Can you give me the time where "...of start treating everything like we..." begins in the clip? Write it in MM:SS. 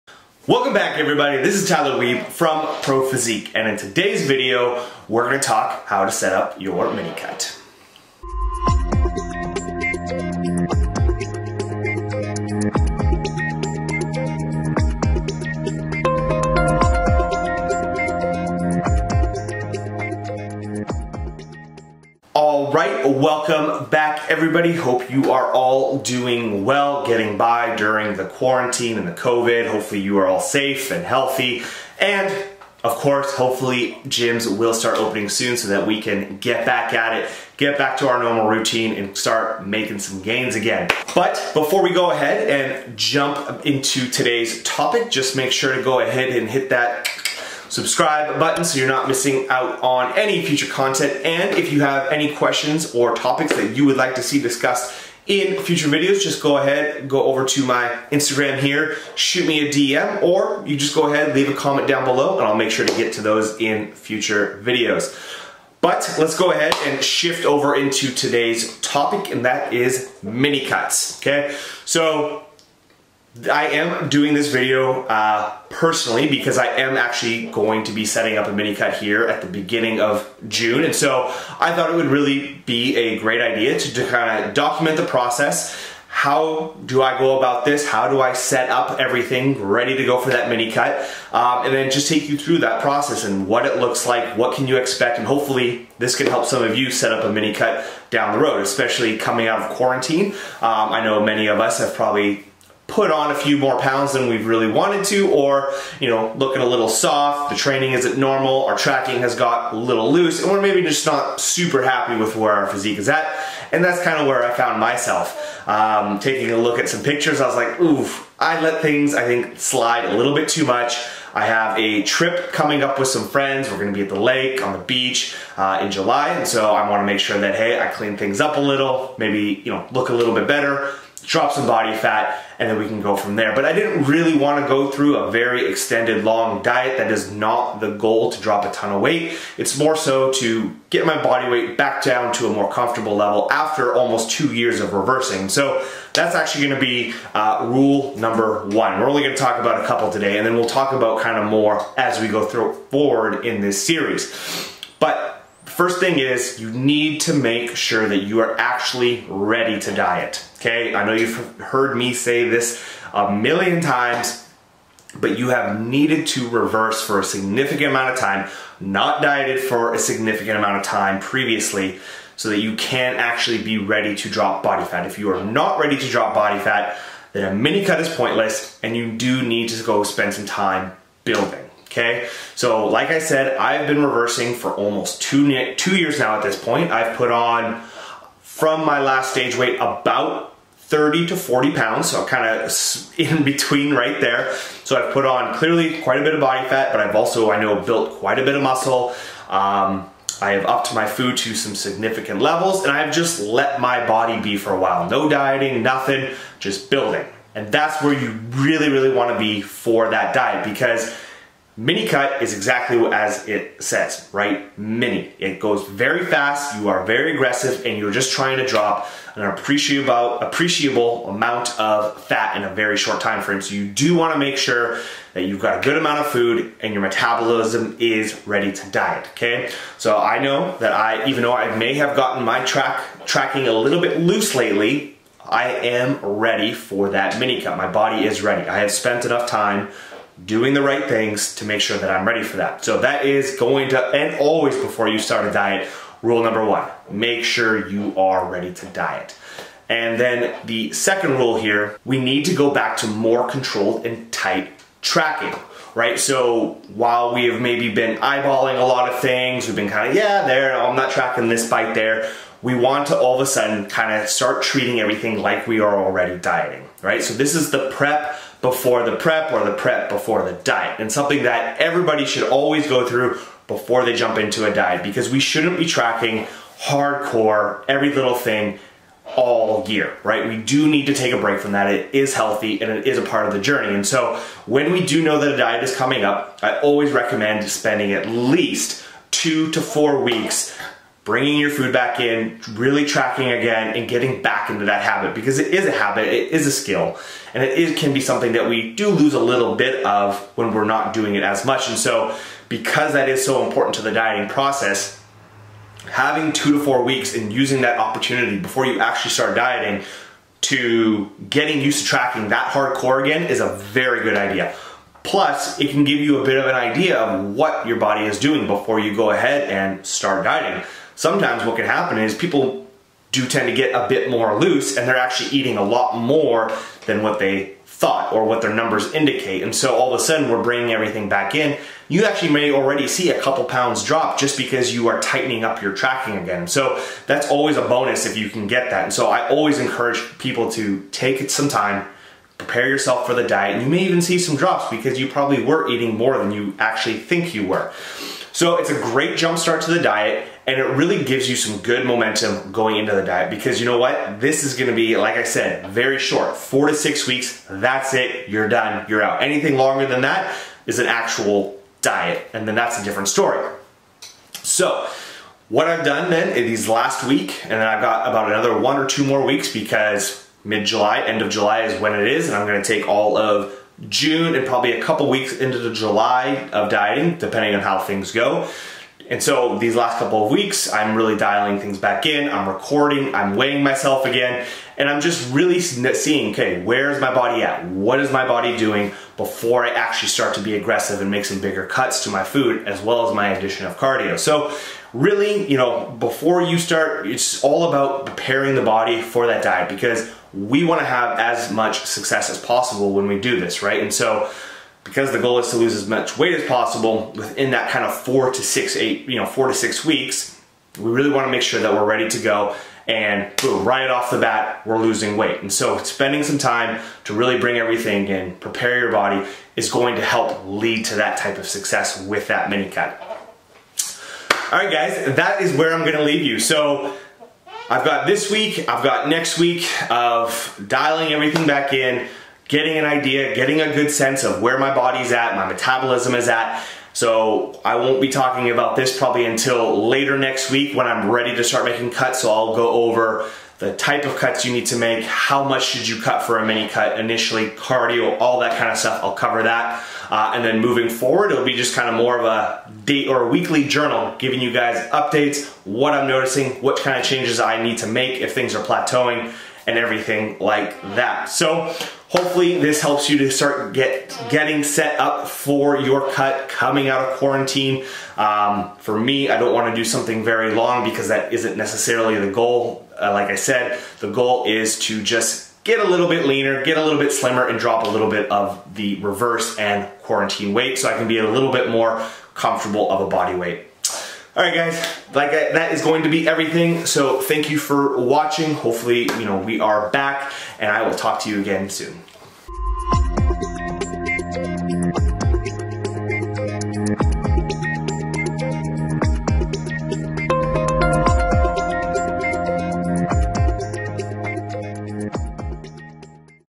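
04:24.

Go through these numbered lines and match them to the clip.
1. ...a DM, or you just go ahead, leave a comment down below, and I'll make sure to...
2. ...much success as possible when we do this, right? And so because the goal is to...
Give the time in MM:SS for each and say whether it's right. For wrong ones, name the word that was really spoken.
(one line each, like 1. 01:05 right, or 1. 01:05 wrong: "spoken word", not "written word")
1. 00:59 right
2. 06:41 right.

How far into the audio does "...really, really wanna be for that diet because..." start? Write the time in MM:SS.
03:28.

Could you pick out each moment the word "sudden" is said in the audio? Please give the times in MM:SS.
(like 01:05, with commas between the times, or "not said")
04:23, 05:30.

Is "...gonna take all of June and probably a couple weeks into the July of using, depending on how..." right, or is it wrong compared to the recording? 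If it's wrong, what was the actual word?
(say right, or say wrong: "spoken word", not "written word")
wrong: "dieting", not "using".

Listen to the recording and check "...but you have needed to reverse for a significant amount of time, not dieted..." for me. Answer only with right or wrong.
right.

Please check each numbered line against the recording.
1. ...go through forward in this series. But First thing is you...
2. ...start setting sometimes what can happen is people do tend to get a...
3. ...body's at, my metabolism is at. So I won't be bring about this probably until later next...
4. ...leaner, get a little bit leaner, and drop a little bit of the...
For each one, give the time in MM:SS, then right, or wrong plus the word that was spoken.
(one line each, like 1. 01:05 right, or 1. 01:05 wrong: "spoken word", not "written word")
1. 02:32 right
2. 05:20 wrong: "dieting", not "setting"
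3. 07:14 wrong: "talking", not "bring"
4. 07:56 wrong: "slimmer", not "leaner".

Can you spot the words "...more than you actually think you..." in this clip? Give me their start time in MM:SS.
05:46.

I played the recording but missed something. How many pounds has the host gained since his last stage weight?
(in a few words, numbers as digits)
30 to 40 pounds.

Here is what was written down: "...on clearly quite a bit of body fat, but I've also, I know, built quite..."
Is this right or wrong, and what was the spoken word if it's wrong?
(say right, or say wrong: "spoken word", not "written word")
right.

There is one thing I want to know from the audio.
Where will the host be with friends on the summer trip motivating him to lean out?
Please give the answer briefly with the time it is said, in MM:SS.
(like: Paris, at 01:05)
the lake, at 02:04.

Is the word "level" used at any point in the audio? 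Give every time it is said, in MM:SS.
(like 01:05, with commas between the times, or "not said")
02:23, 03:22.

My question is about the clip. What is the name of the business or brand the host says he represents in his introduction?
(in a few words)
Pro Physique.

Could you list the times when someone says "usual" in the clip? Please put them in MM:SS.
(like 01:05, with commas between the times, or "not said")
not said.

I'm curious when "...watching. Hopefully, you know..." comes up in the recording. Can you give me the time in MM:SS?
08:08.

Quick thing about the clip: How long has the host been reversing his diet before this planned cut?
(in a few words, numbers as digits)
almost 2 years.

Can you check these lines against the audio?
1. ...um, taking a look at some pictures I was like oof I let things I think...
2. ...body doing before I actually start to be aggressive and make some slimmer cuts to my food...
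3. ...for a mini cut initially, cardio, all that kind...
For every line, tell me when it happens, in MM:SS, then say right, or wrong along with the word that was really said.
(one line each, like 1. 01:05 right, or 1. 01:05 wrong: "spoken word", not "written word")
1. 01:55 right
2. 06:28 wrong: "bigger", not "slimmer"
3. 07:26 right.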